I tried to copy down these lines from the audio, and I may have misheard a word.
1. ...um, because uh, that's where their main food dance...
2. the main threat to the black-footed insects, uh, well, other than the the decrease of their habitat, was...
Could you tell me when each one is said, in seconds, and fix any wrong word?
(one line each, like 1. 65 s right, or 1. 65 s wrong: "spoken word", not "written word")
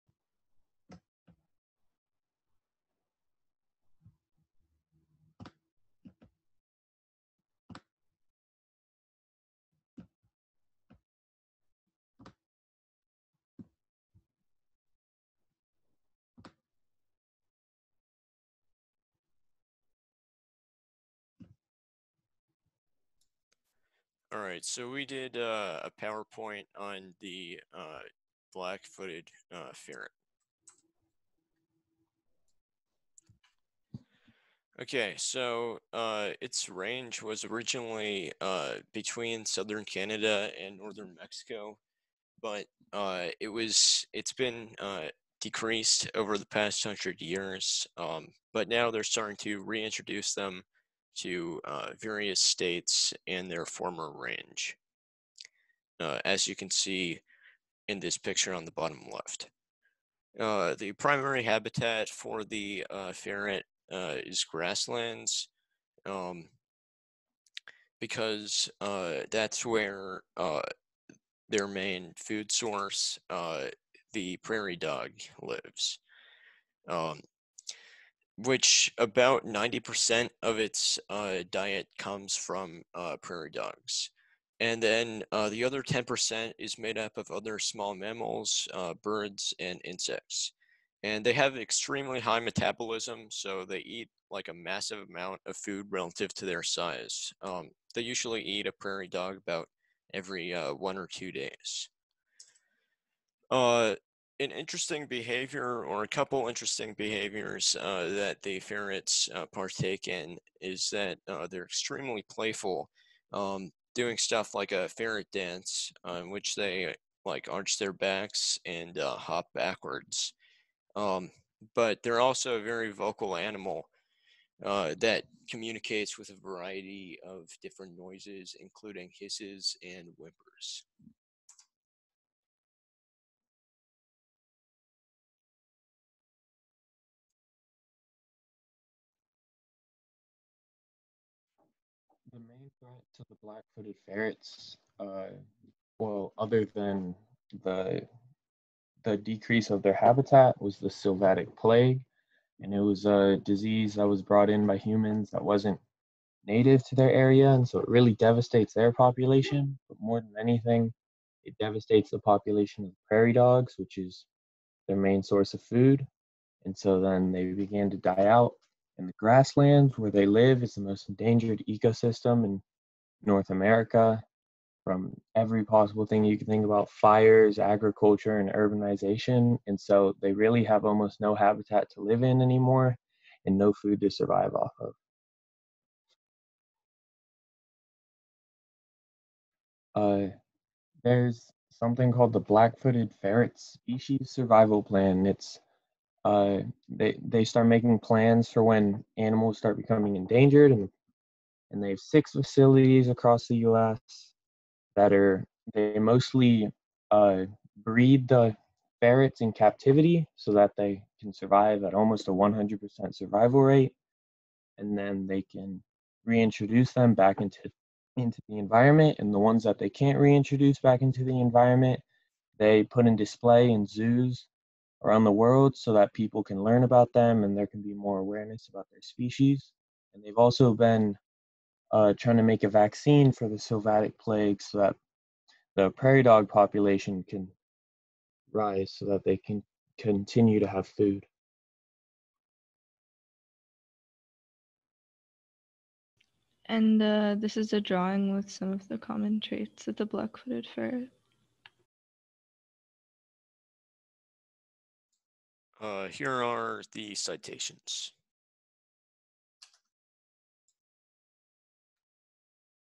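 1. 66 s wrong: "source", not "dance"
2. 142 s wrong: "ferrets", not "insects".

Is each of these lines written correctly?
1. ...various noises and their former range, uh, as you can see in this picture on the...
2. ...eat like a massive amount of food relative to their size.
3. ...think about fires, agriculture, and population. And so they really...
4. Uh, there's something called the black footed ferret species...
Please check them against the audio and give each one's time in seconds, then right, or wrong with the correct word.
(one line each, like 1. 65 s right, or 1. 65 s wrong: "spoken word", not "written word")
1. 51 s wrong: "states", not "noises"
2. 93 s right
3. 176 s wrong: "urbanization", not "population"
4. 189 s right.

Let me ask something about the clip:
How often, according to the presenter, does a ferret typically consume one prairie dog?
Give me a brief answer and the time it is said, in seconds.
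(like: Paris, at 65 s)
Every 1 or 2 days, at 100 s.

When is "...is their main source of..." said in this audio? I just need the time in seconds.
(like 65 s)
163 s.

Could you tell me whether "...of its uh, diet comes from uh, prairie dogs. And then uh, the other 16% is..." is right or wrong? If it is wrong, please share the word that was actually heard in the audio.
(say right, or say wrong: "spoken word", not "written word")
wrong: "10", not "16".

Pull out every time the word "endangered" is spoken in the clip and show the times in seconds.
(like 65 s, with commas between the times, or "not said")
171 s, 200 s.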